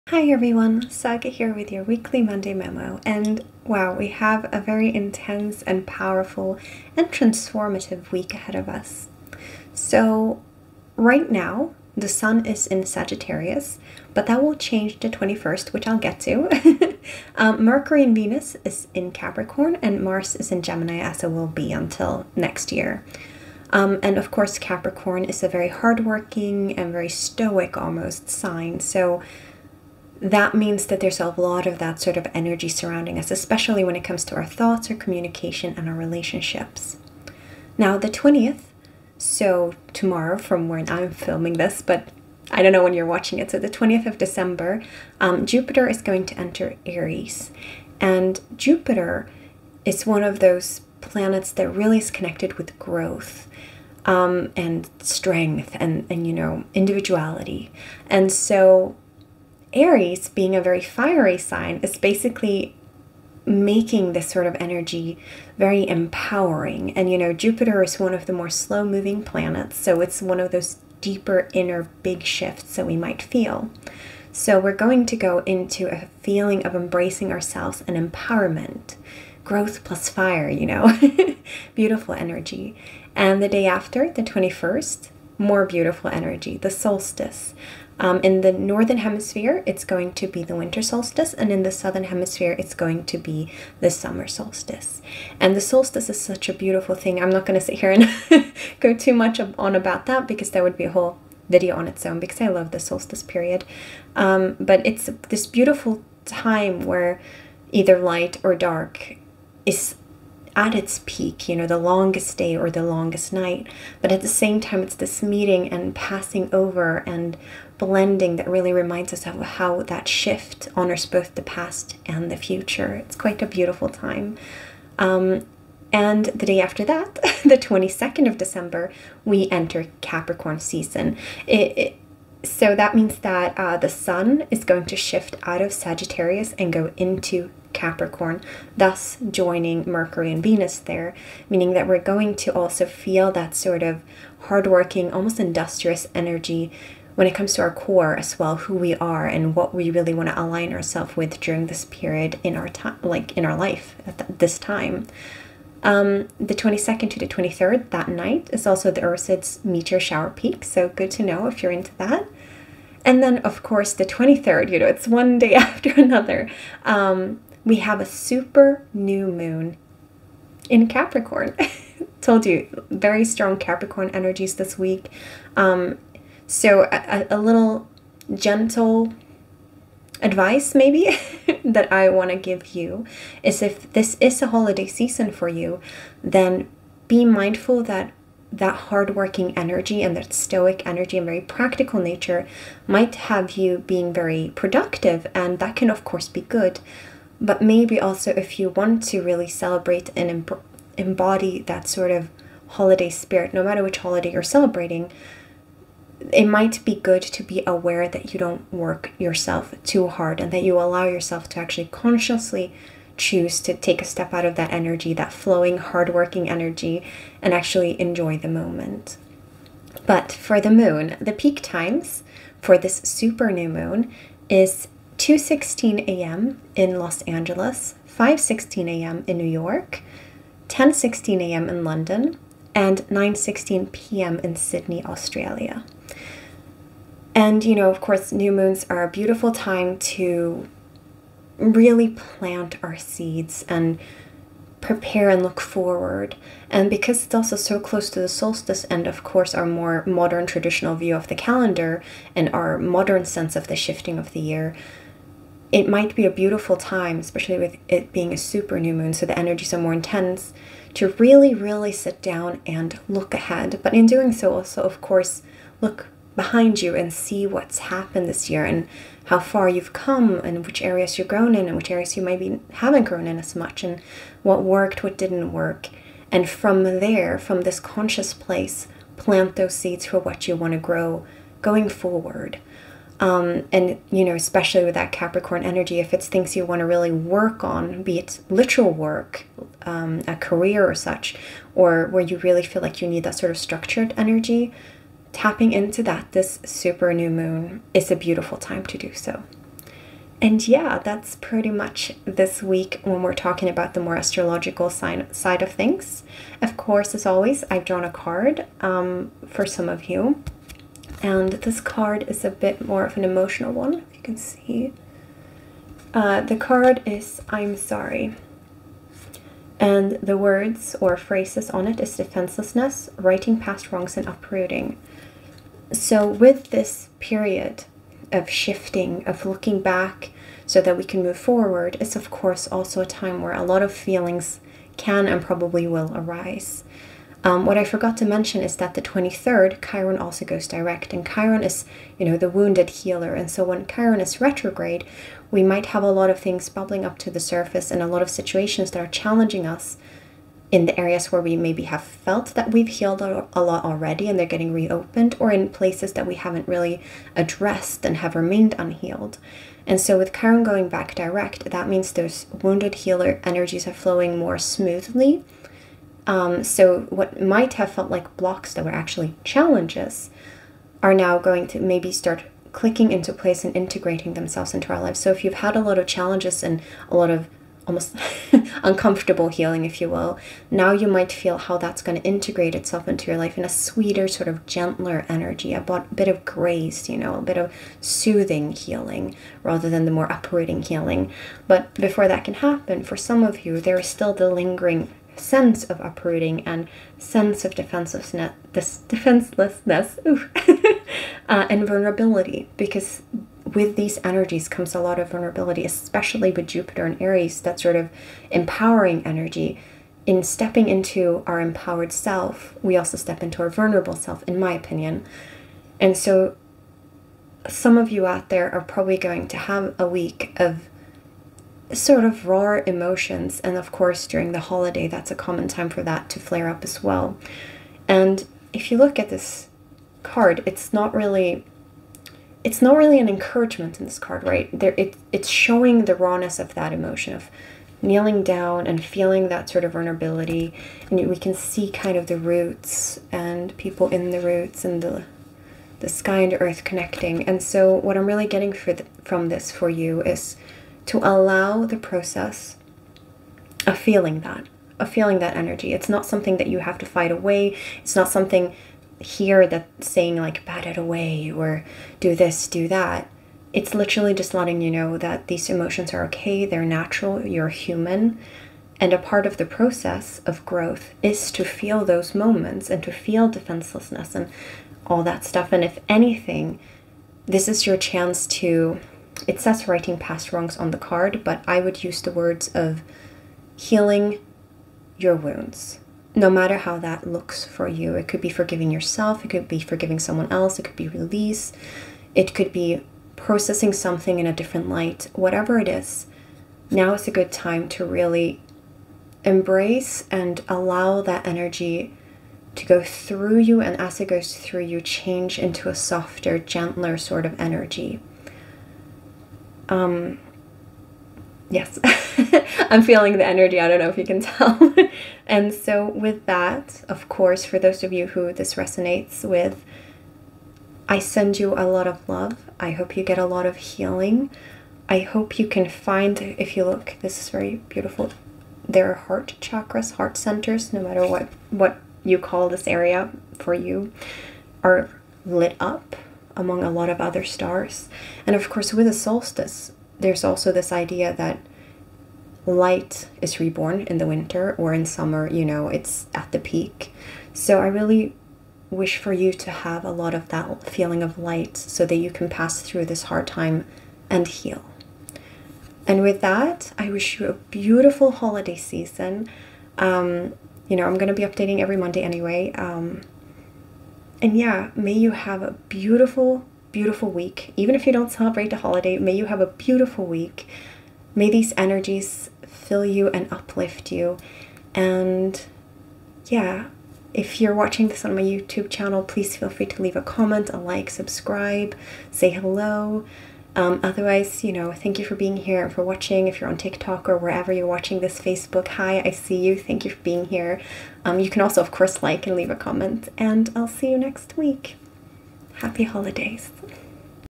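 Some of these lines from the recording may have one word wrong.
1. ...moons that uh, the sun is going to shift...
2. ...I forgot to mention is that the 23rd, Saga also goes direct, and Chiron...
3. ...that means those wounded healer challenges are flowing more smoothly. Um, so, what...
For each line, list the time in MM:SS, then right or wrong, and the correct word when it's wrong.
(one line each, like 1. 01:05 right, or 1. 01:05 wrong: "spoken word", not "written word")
1. 02:12 wrong: "means", not "moons"
2. 05:37 wrong: "Chiron", not "Saga"
3. 06:01 wrong: "energies", not "challenges".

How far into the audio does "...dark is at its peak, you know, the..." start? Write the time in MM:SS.
01:48.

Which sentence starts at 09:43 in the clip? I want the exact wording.
Um, otherwise, you know, thank you for being here and for watching.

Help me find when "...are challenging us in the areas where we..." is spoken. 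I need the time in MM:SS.
05:49.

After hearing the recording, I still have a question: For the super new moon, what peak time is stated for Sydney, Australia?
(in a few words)
9:16 p.m.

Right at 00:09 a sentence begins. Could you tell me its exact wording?
So, right now, the sun is in Sagittarius, but that will change the 21st, which I'll get to.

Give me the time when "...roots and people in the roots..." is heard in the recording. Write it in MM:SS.
07:22.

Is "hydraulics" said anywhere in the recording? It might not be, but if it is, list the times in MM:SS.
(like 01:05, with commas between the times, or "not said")
not said.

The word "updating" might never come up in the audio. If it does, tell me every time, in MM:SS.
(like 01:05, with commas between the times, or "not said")
09:21.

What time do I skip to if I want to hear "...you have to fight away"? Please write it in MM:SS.
07:36.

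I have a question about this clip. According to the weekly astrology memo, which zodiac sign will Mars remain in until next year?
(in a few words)
Gemini.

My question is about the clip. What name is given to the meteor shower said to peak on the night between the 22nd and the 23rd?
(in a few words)
Ursids.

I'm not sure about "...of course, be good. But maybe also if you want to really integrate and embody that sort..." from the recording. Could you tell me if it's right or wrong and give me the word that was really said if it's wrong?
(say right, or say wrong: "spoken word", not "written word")
wrong: "celebrate", not "integrate".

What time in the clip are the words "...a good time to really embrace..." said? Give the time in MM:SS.
08:17.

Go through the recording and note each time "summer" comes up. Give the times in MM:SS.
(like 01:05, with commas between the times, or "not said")
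01:33, 09:05.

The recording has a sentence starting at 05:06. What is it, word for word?
Of course, as always, I've drawn a card um, for some of you.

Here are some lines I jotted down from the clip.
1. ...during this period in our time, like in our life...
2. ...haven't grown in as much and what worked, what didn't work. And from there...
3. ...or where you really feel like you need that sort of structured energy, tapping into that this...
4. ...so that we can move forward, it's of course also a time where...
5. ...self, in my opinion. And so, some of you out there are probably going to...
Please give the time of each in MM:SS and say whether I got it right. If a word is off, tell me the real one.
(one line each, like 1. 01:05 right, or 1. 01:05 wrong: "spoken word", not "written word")
1. 02:31 right
2. 04:32 right
3. 04:51 right
4. 05:30 right
5. 06:54 right.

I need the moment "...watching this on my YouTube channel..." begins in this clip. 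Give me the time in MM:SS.
09:37.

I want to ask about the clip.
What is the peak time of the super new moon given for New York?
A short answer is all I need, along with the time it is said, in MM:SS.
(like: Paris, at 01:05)
5:16 a.m., at 03:48.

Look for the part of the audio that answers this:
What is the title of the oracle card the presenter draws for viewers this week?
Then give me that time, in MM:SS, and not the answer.
05:16.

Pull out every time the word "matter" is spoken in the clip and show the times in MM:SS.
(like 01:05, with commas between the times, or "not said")
03:23, 08:06, 08:51.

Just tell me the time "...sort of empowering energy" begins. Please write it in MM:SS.
06:47.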